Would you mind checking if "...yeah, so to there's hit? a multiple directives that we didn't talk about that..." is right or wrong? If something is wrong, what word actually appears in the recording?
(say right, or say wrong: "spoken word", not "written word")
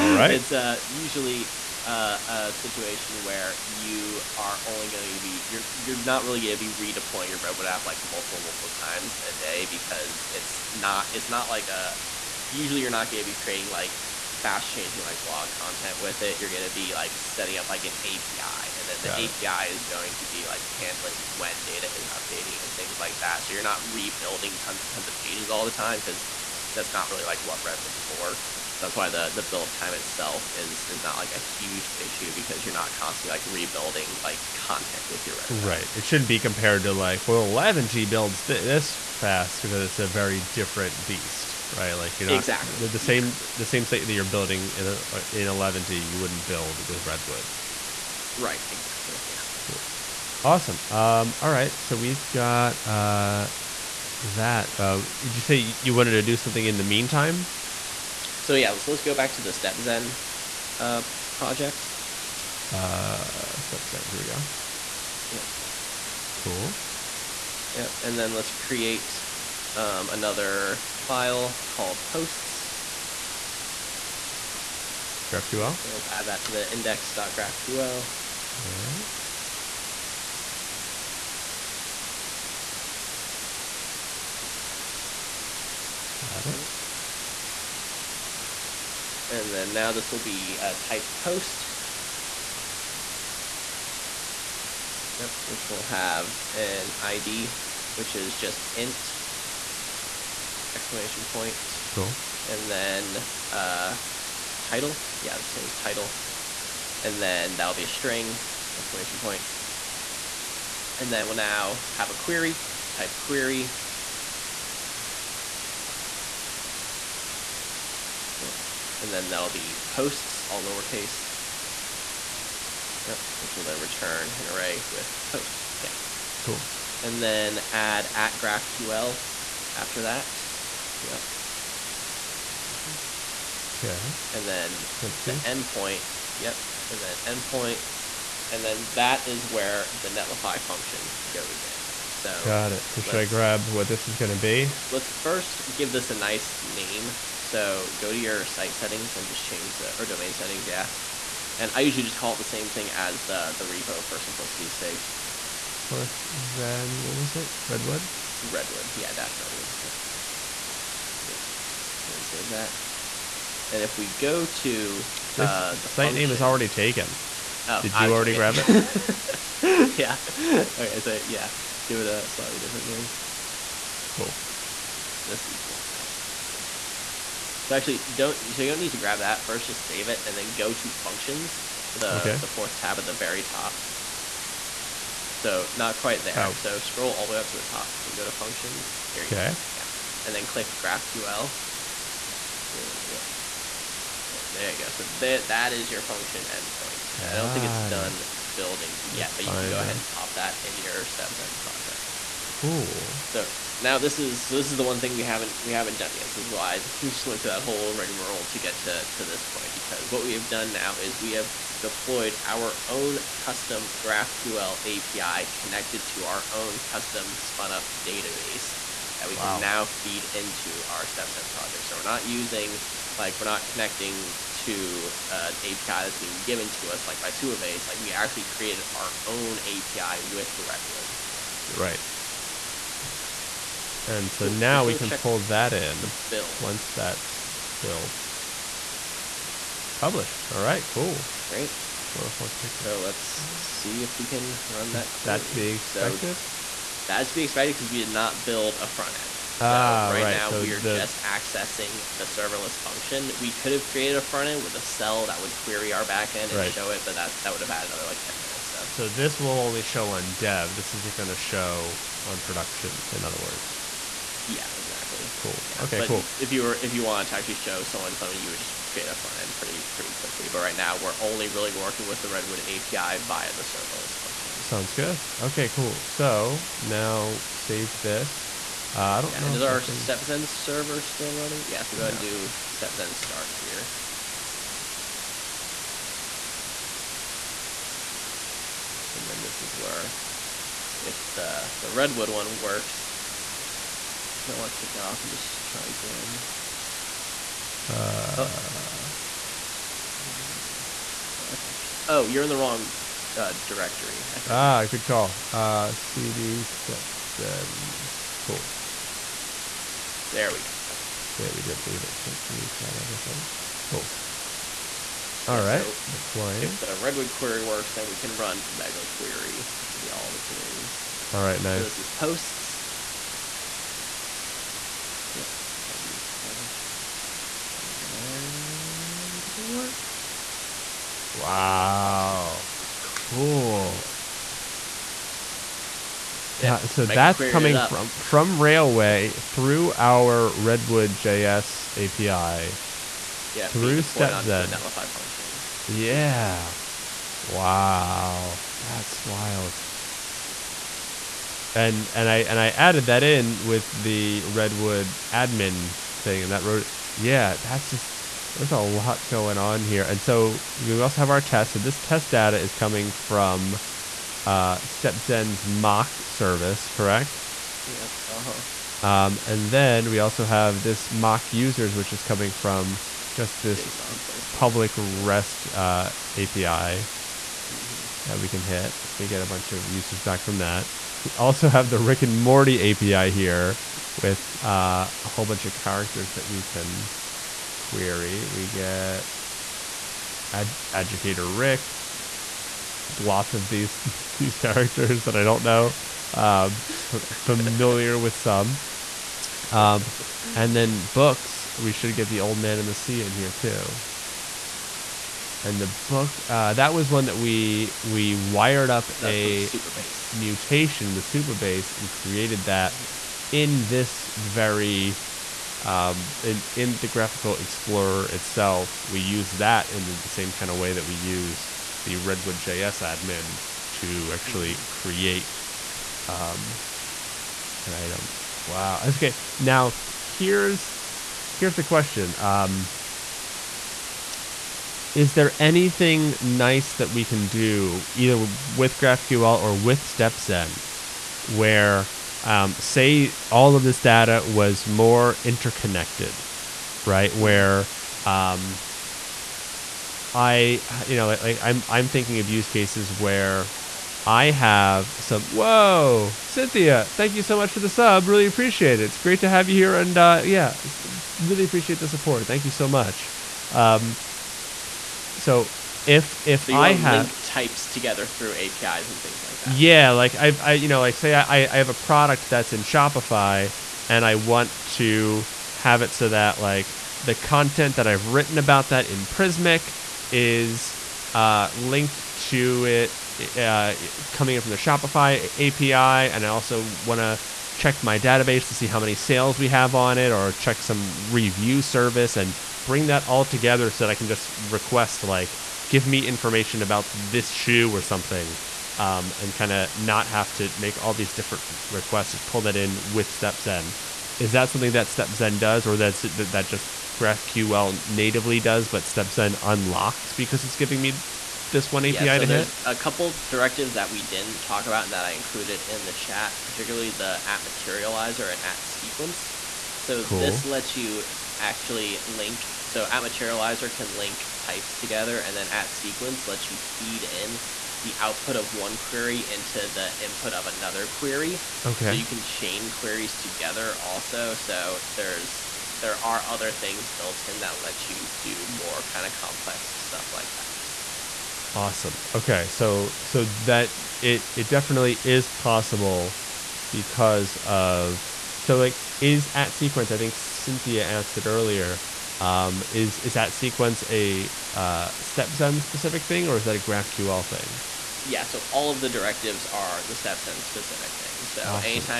wrong: "couple", not "multiple".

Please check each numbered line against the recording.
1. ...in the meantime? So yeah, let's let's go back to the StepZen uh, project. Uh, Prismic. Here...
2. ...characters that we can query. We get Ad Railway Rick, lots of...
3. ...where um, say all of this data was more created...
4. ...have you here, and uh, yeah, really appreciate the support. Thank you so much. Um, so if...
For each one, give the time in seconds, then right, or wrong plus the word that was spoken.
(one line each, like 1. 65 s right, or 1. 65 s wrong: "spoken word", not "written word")
1. 56 s wrong: "StepZen", not "Prismic"
2. 385 s wrong: "Educator", not "Railway"
3. 441 s wrong: "interconnected", not "created"
4. 459 s right.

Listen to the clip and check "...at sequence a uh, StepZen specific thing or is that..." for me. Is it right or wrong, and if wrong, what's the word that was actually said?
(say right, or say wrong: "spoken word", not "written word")
right.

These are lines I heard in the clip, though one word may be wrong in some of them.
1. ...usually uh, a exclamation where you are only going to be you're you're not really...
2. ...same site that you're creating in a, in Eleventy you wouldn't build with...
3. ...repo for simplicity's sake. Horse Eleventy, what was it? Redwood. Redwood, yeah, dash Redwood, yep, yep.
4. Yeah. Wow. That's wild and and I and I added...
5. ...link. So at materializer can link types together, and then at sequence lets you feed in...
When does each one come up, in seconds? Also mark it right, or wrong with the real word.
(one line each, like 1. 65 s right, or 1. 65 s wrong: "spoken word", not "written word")
1. 0 s wrong: "situation", not "exclamation"
2. 43 s wrong: "building", not "creating"
3. 153 s wrong: "Zen", not "Eleventy"
4. 345 s right
5. 522 s right.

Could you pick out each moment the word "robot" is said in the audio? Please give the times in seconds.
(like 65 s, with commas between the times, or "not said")
7 s.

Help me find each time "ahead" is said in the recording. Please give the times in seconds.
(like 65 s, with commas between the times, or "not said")
199 s, 282 s.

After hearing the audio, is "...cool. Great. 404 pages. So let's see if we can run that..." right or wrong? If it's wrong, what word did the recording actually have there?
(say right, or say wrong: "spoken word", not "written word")
right.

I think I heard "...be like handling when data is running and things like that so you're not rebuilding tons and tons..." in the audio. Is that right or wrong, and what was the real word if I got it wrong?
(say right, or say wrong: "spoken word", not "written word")
wrong: "updating", not "running".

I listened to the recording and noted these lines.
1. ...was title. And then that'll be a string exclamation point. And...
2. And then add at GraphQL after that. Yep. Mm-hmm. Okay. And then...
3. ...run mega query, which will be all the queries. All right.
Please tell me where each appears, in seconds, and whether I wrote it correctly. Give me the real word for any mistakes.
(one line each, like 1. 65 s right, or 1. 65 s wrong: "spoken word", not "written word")
1. 105 s right
2. 127 s right
3. 318 s right.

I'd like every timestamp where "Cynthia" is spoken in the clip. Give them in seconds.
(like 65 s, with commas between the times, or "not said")
456 s, 550 s.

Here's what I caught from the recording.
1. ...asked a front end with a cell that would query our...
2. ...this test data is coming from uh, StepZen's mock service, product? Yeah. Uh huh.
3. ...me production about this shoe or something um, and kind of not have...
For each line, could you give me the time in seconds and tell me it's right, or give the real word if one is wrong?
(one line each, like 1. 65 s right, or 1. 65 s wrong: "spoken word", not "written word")
1. 253 s wrong: "created", not "asked"
2. 361 s wrong: "correct", not "product"
3. 496 s wrong: "information", not "production".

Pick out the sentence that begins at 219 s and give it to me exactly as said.
can now feed into our StepZen project.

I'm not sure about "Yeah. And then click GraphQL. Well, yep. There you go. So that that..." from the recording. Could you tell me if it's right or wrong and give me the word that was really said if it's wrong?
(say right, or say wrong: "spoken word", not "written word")
right.